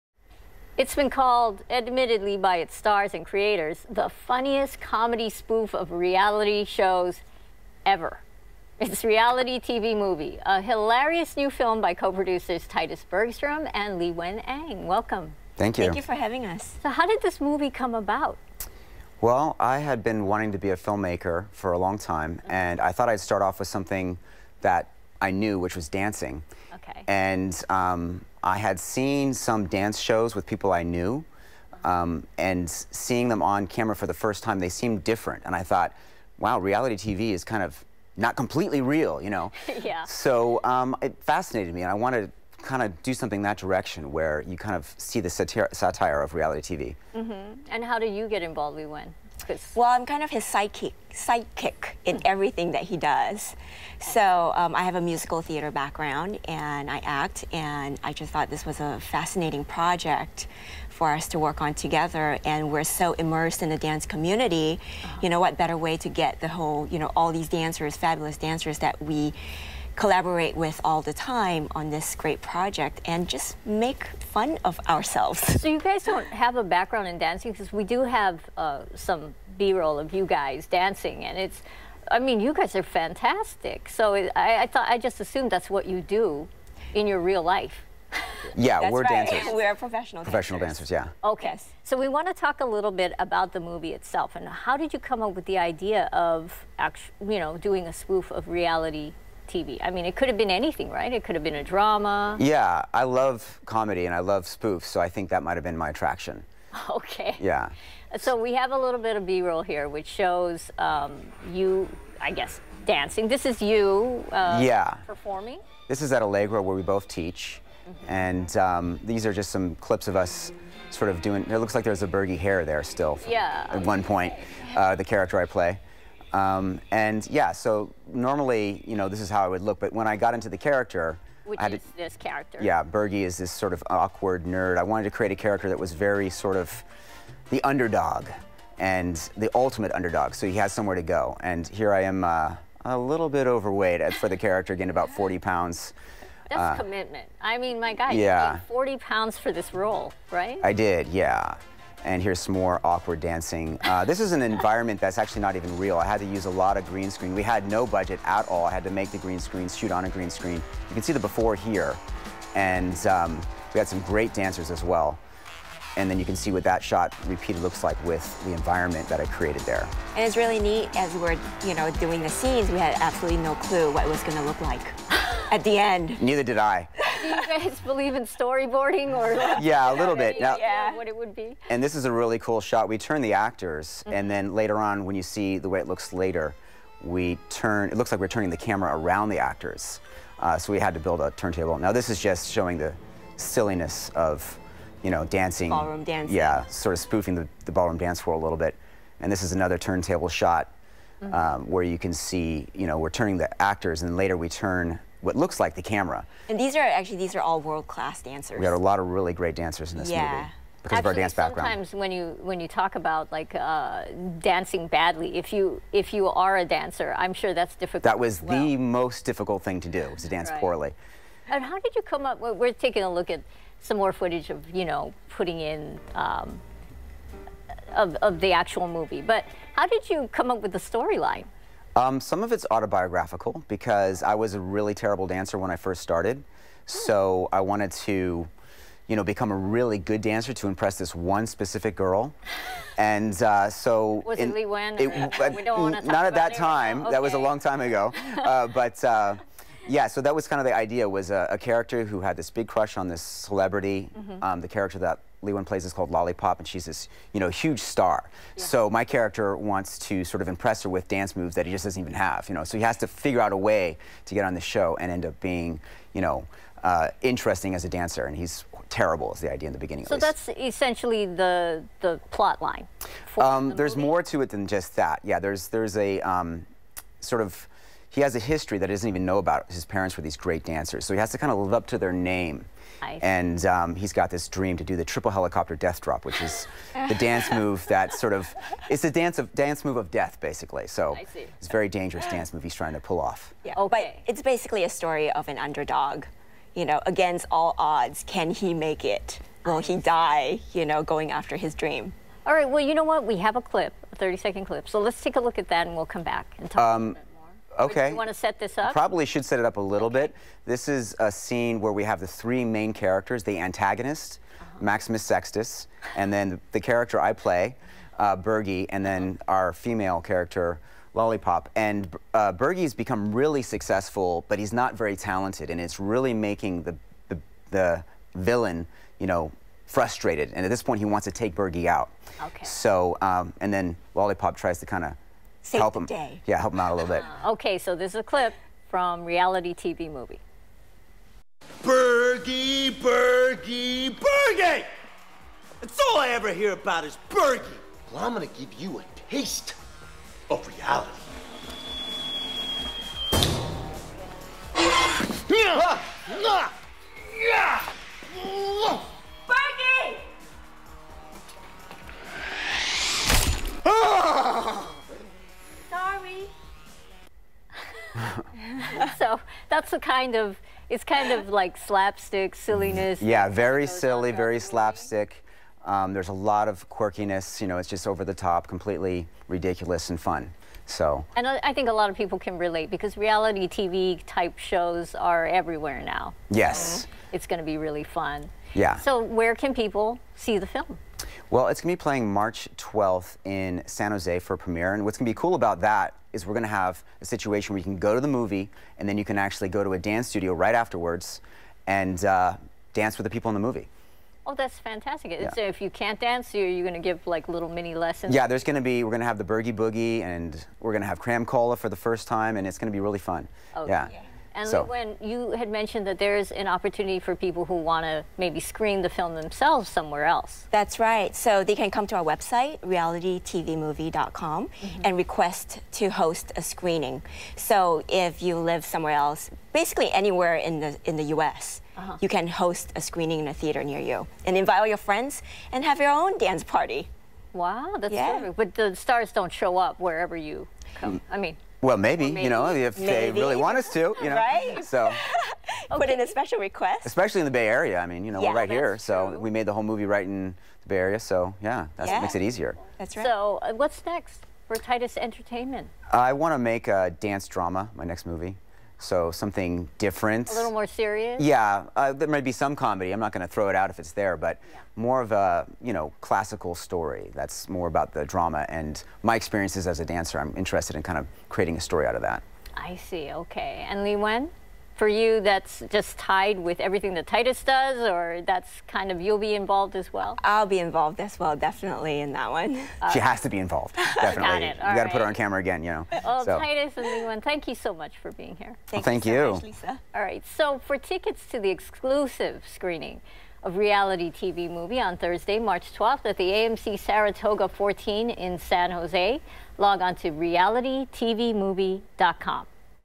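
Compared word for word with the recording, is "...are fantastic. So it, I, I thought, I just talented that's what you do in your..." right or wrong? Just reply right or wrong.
wrong.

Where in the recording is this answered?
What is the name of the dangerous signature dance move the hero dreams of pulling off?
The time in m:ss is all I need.
4:45.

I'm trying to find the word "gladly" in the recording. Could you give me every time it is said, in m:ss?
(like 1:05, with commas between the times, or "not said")
not said.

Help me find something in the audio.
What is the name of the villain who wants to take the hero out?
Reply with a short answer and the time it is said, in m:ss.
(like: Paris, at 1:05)
Maximus Sextus, at 5:14.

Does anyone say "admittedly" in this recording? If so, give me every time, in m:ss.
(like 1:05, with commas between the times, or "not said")
0:01.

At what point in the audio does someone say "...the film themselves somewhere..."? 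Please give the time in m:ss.
6:59.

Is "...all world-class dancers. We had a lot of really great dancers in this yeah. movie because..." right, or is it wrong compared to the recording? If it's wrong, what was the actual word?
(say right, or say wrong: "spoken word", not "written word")
right.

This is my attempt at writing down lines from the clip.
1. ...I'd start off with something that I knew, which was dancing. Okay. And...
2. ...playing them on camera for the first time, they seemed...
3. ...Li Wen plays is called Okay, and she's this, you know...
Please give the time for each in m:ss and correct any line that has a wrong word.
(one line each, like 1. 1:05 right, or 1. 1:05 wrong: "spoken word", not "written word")
1. 0:23 right
2. 0:32 wrong: "seeing", not "playing"
3. 4:15 wrong: "Lollipop", not "Okay".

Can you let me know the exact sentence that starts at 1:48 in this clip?
So we have a little bit of B-roll here, which shows um, you, I guess, dancing.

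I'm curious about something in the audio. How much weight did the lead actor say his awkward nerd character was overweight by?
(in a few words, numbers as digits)
40 pounds.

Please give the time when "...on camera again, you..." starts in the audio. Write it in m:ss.
8:05.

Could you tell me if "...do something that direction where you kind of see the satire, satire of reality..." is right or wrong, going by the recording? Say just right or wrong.
right.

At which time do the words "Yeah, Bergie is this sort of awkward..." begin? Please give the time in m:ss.
2:12.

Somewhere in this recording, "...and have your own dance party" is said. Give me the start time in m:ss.
7:15.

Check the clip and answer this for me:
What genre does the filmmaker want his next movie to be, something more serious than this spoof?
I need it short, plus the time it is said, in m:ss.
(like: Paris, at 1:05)
Dance drama, at 7:37.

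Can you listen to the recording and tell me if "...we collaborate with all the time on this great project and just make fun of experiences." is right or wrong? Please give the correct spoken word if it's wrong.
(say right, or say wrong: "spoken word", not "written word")
wrong: "ourselves", not "experiences".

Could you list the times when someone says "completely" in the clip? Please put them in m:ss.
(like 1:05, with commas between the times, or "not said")
0:38, 6:18.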